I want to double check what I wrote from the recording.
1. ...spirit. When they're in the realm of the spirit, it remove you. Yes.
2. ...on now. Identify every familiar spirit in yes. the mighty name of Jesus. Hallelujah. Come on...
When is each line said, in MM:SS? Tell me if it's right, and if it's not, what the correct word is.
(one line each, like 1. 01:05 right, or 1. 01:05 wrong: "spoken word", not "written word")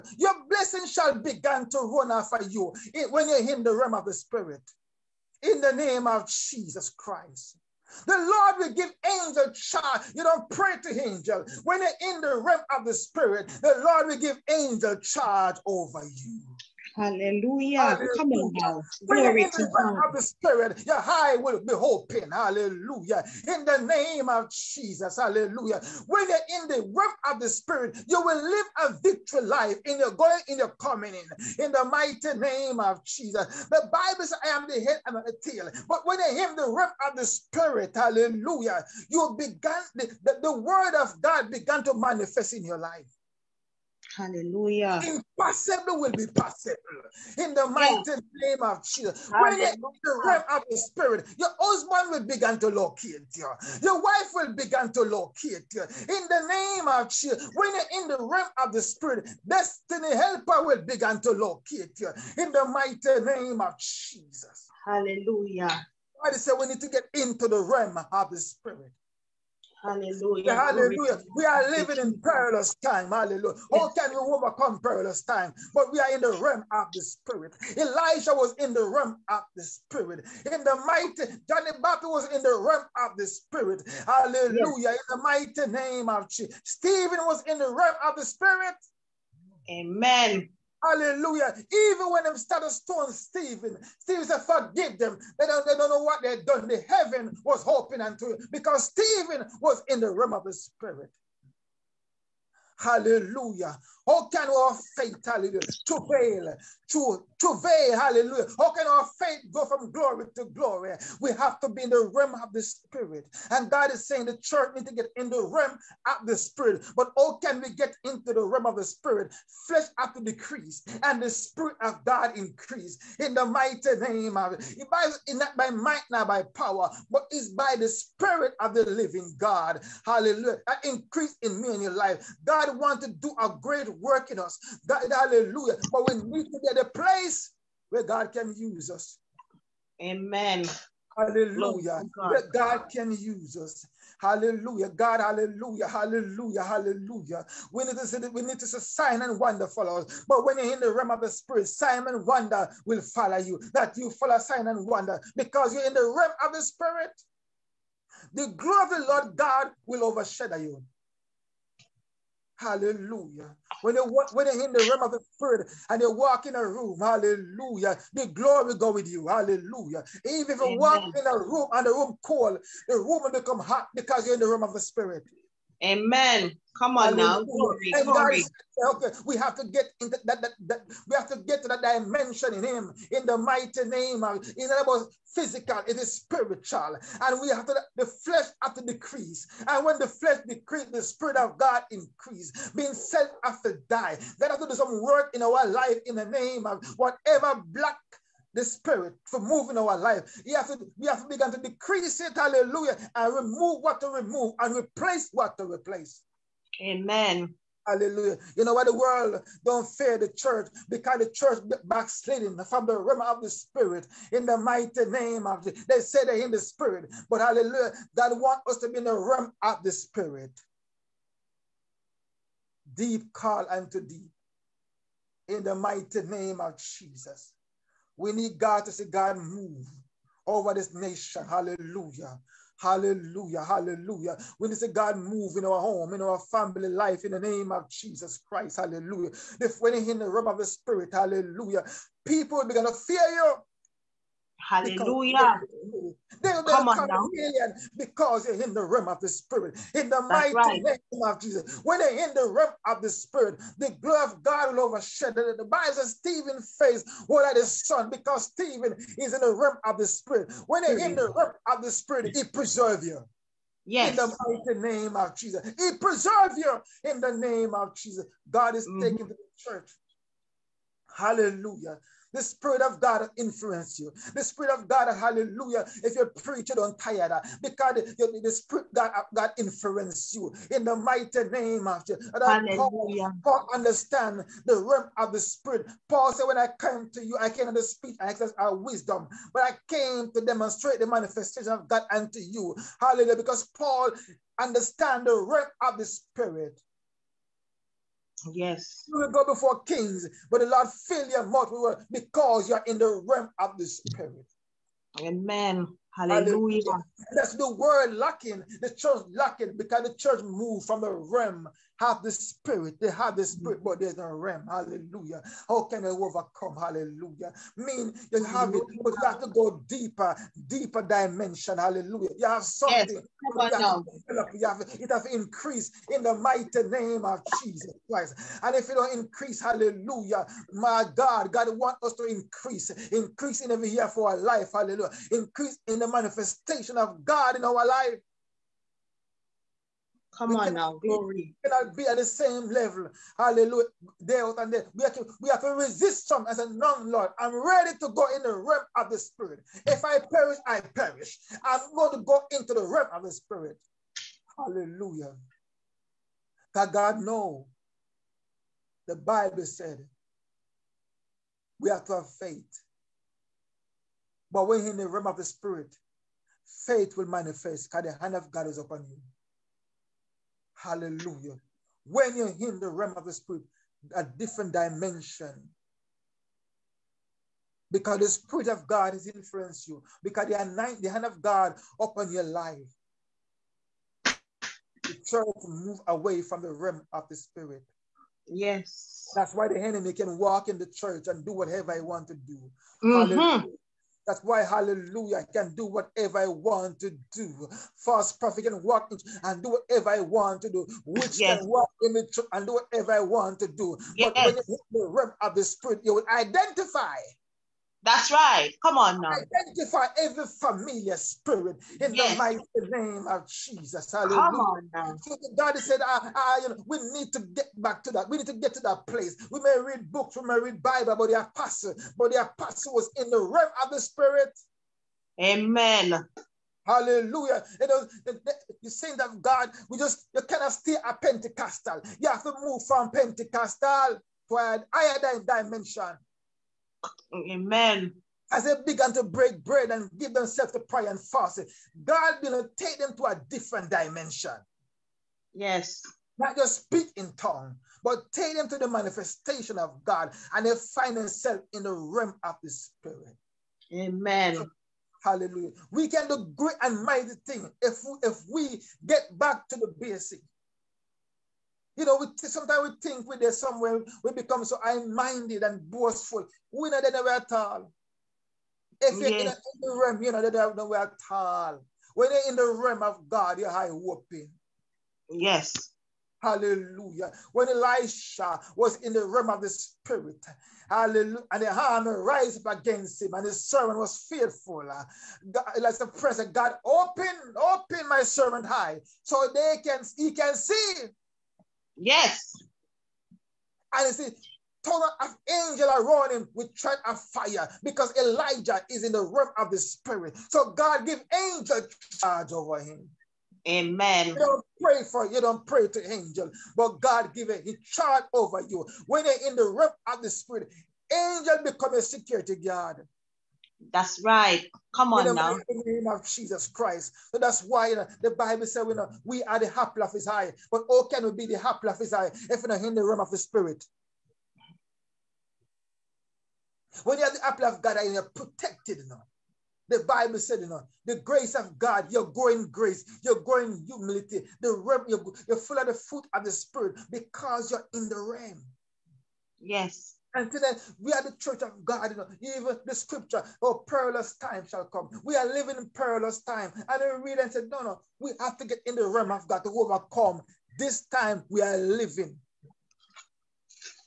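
1. 04:20 wrong: "preserve", not "remove"
2. 06:48 right.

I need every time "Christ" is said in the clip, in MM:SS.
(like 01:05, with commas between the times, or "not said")
00:06, 03:58, 05:28, 08:36.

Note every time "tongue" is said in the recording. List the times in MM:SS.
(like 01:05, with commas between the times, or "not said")
07:27, 08:14.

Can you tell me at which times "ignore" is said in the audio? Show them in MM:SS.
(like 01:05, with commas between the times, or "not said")
not said.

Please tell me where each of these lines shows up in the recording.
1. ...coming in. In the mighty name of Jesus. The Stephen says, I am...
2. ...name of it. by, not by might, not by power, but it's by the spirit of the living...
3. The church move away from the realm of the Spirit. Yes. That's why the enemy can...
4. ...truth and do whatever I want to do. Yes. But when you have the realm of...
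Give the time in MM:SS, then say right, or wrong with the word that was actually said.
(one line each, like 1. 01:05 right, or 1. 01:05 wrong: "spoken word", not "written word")
1. 00:30 wrong: "Bible", not "Stephen"
2. 02:03 right
3. 06:25 right
4. 06:42 right.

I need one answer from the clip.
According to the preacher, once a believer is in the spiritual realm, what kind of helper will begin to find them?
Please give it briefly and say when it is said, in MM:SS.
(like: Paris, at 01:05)
Destiny helper, at 00:59.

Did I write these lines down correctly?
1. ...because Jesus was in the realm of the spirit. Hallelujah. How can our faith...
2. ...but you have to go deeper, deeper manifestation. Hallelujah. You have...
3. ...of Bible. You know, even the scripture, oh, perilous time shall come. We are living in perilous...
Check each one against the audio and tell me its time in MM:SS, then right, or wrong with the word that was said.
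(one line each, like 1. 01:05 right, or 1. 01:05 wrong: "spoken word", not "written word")
1. 01:38 wrong: "Stephen", not "Jesus"
2. 05:19 wrong: "dimension", not "manifestation"
3. 09:01 wrong: "God", not "Bible".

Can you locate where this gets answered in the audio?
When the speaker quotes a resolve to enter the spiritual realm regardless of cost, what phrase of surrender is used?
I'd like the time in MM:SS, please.
05:49.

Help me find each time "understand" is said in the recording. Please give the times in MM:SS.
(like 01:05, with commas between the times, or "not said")
04:43, 04:54.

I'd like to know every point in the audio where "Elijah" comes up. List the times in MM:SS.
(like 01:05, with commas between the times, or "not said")
01:17, 08:18.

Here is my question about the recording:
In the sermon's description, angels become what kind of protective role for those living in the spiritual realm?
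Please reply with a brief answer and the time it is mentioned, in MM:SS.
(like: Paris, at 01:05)
Security guard, at 08:31.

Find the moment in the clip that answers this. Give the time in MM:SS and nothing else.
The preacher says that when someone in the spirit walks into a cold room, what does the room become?
02:52.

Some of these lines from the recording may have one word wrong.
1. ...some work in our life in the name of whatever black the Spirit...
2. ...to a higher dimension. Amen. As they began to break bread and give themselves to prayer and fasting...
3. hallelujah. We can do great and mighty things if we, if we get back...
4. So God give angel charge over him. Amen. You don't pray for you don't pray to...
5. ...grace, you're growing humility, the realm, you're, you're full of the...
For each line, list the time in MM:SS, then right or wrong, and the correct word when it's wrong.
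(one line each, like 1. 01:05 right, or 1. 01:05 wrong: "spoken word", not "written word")
1. 03:14 right
2. 07:14 right
3. 07:35 right
4. 08:20 right
5. 08:52 right.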